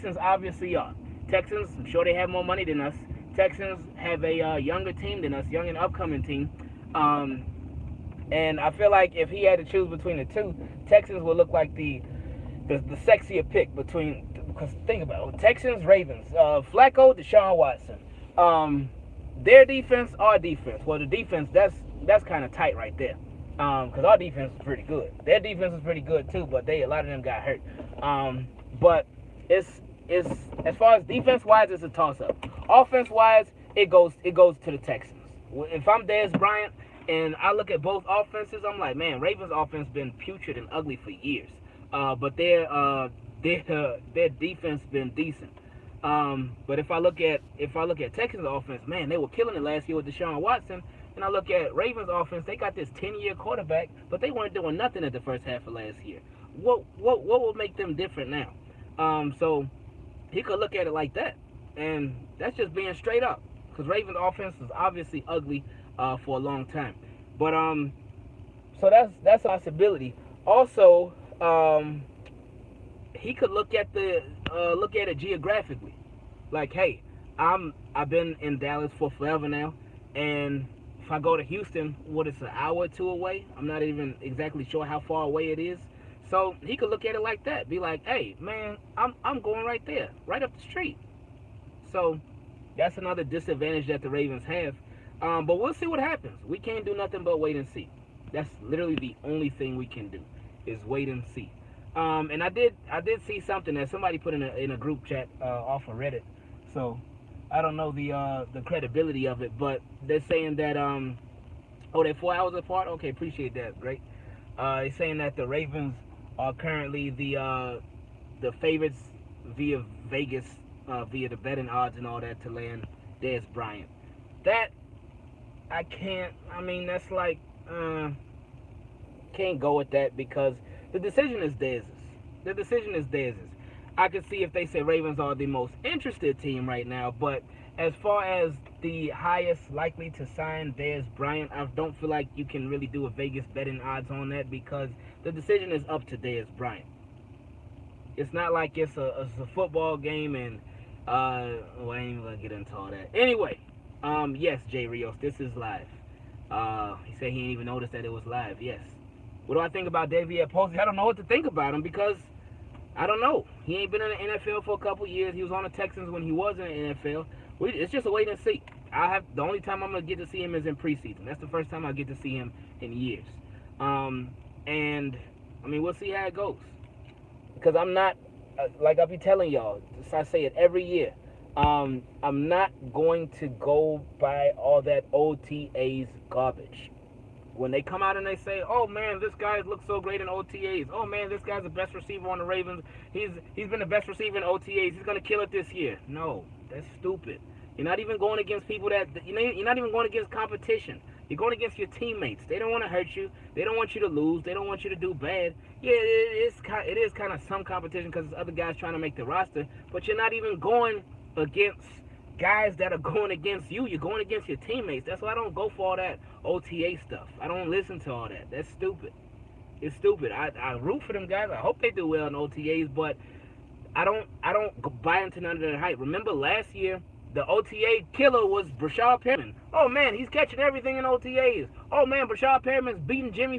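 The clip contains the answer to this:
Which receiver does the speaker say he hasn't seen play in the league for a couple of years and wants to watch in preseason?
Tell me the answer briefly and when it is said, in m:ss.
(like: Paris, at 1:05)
DeVier Posey, at 2:40.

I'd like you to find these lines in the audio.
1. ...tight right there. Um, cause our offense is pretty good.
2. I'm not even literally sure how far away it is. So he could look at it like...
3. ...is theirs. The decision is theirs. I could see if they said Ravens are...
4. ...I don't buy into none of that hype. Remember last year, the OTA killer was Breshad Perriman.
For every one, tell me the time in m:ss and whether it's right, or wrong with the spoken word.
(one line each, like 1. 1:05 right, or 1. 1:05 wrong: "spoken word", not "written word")
1. 0:22 wrong: "defense", not "offense"
2. 1:23 wrong: "exactly", not "literally"
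3. 2:11 right
4. 3:44 right.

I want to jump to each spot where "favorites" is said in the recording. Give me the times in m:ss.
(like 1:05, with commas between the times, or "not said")
1:58.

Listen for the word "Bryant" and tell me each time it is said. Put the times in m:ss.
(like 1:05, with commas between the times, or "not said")
0:36, 2:03, 2:21, 2:26.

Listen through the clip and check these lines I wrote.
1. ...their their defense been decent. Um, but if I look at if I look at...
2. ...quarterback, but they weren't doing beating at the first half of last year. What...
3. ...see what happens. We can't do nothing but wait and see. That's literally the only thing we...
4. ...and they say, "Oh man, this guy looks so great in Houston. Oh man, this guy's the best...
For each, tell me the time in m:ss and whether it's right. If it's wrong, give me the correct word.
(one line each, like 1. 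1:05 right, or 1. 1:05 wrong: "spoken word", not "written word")
1. 0:43 right
2. 0:53 wrong: "nothing", not "beating"
3. 1:35 right
4. 3:08 wrong: "OTAs", not "Houston".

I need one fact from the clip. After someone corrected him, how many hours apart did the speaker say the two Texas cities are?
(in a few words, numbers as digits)
4.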